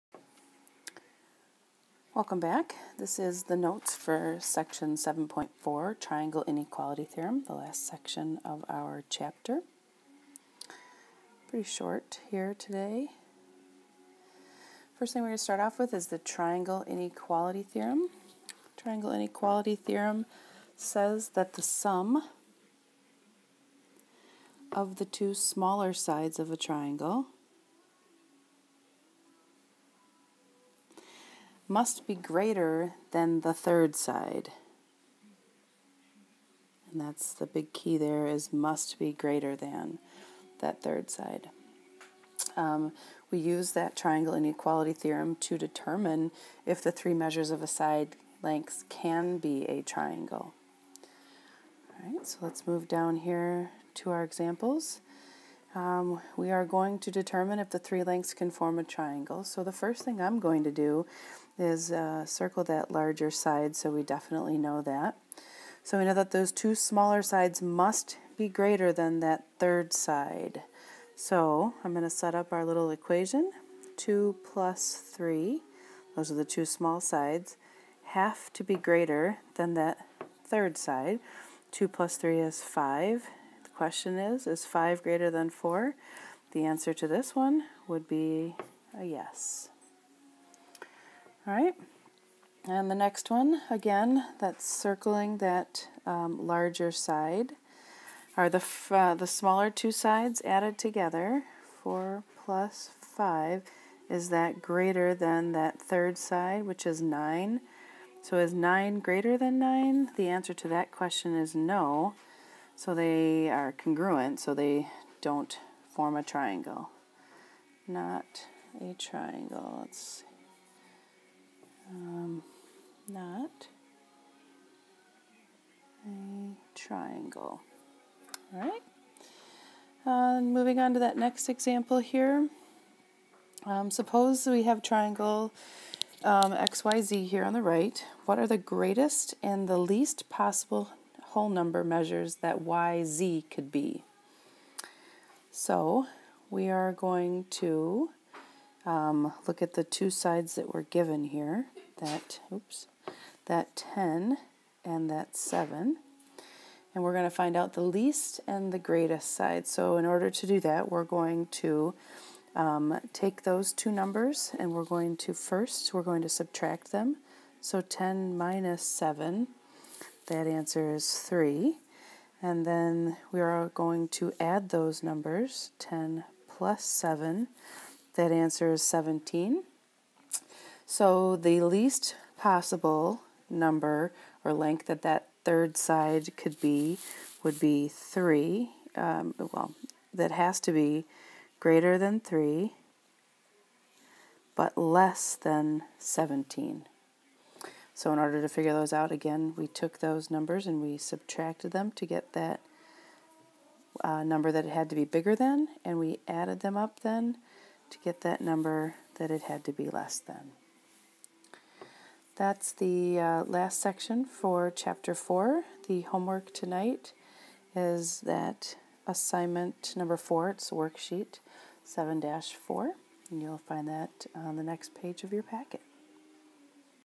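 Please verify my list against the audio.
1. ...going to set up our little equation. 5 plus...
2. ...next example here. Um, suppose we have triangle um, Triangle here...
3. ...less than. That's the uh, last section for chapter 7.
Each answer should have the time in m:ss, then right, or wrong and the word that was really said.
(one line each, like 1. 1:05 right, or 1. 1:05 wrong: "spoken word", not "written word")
1. 1:11 wrong: "2", not "5"
2. 2:11 wrong: "XYZ", not "Triangle"
3. 3:29 wrong: "4", not "7".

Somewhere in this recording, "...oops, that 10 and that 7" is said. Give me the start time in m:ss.
2:32.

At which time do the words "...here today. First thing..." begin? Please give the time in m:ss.
0:12.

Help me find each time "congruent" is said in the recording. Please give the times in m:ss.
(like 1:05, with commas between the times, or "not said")
1:53.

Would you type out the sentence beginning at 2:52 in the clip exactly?
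And then we are going to add those numbers 10 plus 7.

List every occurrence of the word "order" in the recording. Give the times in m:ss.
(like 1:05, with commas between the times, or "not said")
2:40, 3:18.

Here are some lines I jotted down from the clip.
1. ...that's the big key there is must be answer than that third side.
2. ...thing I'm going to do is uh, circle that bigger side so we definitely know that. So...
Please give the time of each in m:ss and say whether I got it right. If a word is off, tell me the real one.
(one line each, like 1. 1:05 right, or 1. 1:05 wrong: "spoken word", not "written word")
1. 0:36 wrong: "greater", not "answer"
2. 1:00 wrong: "larger", not "bigger".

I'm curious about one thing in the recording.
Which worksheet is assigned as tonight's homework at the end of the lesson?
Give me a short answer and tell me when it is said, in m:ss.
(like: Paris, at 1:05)
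worksheet 7 4, at 3:40.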